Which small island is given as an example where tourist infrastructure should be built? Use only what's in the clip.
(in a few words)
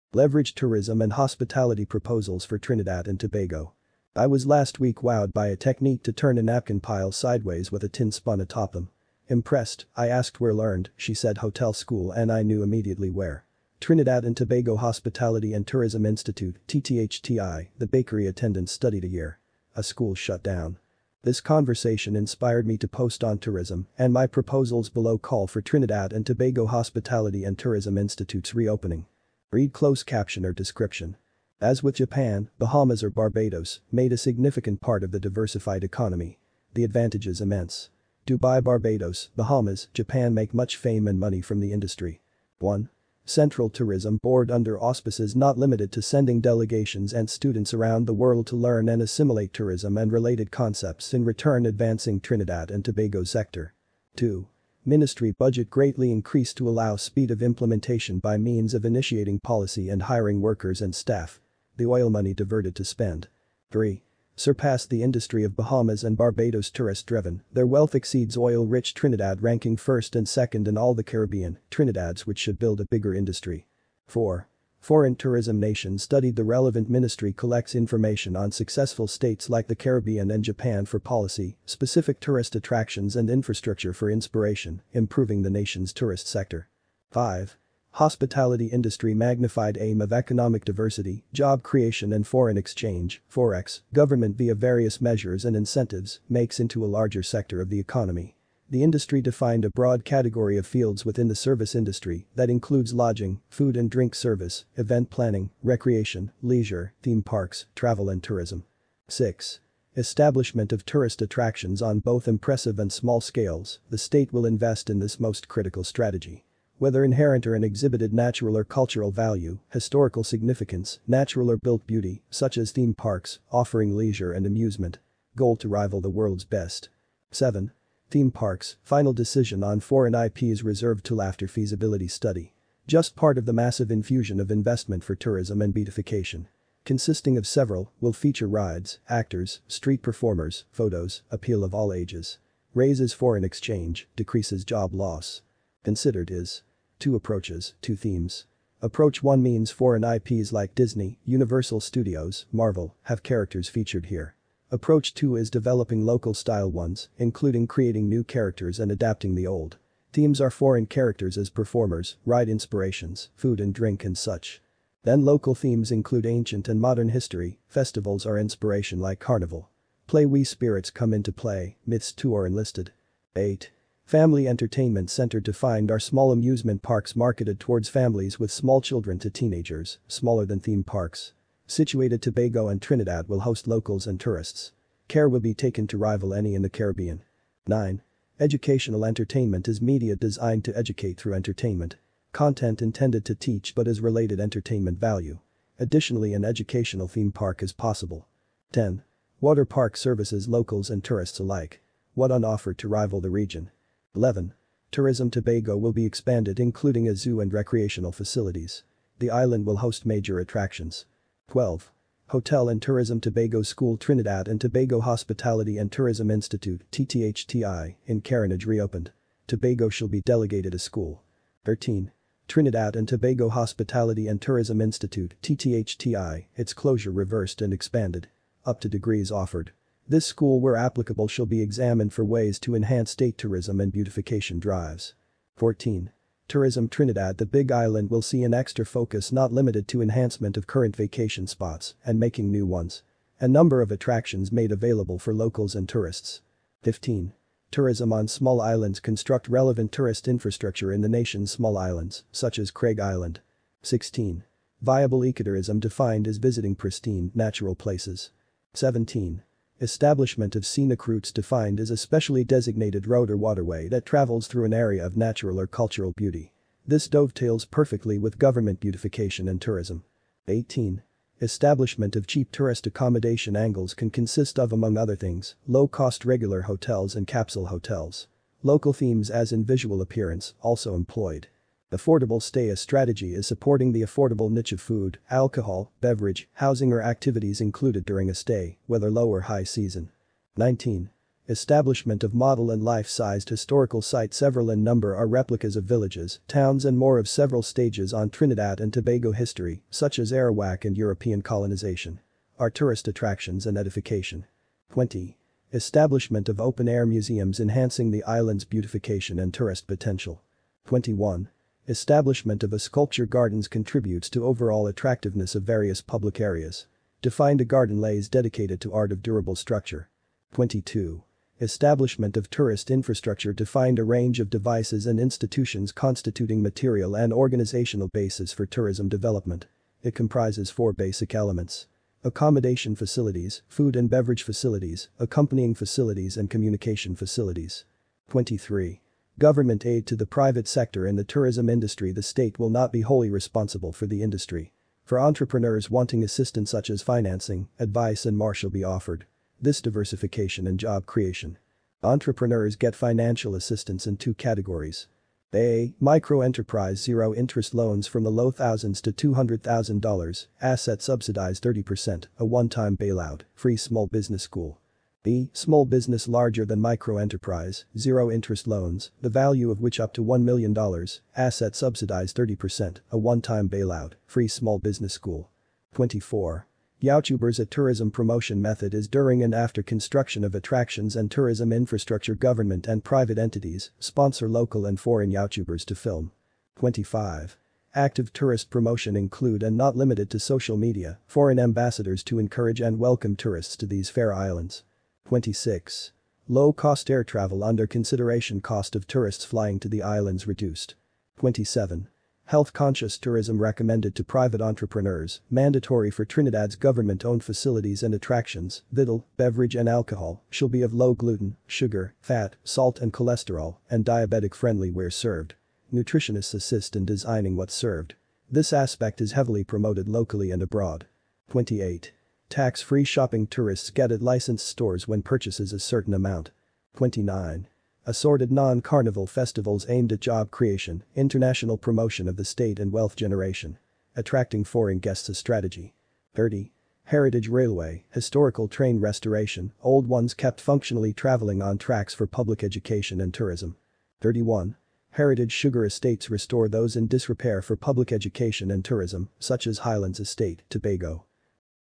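Craig Island.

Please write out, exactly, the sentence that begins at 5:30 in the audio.
It comprises four basic elements accommodation facilities, food and beverage facilities, accompanying facilities and communication facilities.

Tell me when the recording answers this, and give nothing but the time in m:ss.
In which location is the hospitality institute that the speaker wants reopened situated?
3:38.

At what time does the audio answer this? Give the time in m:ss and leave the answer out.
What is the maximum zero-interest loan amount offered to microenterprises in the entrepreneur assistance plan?
5:59.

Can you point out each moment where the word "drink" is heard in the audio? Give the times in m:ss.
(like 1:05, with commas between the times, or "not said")
1:43, 2:43.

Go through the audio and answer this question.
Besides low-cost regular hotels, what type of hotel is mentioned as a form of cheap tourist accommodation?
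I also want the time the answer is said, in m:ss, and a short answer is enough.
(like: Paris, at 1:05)
capsule hotels, at 4:37.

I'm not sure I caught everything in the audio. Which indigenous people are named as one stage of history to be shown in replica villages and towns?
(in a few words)
Arawak.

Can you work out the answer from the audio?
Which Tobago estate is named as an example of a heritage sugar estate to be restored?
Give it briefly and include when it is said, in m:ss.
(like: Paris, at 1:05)
Highlands Estate, at 7:29.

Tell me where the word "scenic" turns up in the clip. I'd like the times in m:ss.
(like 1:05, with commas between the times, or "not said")
4:20.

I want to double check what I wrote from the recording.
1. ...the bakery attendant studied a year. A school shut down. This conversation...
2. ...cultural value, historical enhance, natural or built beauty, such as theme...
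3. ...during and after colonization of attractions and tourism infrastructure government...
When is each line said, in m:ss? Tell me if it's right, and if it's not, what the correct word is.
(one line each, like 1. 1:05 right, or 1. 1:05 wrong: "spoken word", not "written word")
1. 0:17 right
2. 1:58 wrong: "significance", not "enhance"
3. 6:19 wrong: "construction", not "colonization".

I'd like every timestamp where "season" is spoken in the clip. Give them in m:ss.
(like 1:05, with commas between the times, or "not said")
4:49.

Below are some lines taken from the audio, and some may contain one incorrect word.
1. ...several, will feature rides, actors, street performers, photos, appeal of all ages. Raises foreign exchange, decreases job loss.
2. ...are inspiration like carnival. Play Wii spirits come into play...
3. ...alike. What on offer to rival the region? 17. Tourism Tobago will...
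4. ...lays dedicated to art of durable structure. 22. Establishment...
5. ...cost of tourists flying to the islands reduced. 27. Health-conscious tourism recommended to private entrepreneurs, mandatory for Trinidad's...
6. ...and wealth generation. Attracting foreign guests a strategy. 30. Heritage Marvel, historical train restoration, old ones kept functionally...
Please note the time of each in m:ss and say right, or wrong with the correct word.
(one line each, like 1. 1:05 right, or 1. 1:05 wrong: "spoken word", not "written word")
1. 2:17 right
2. 2:48 right
3. 3:21 wrong: "11", not "17"
4. 5:17 right
5. 6:38 right
6. 7:12 wrong: "Railway", not "Marvel".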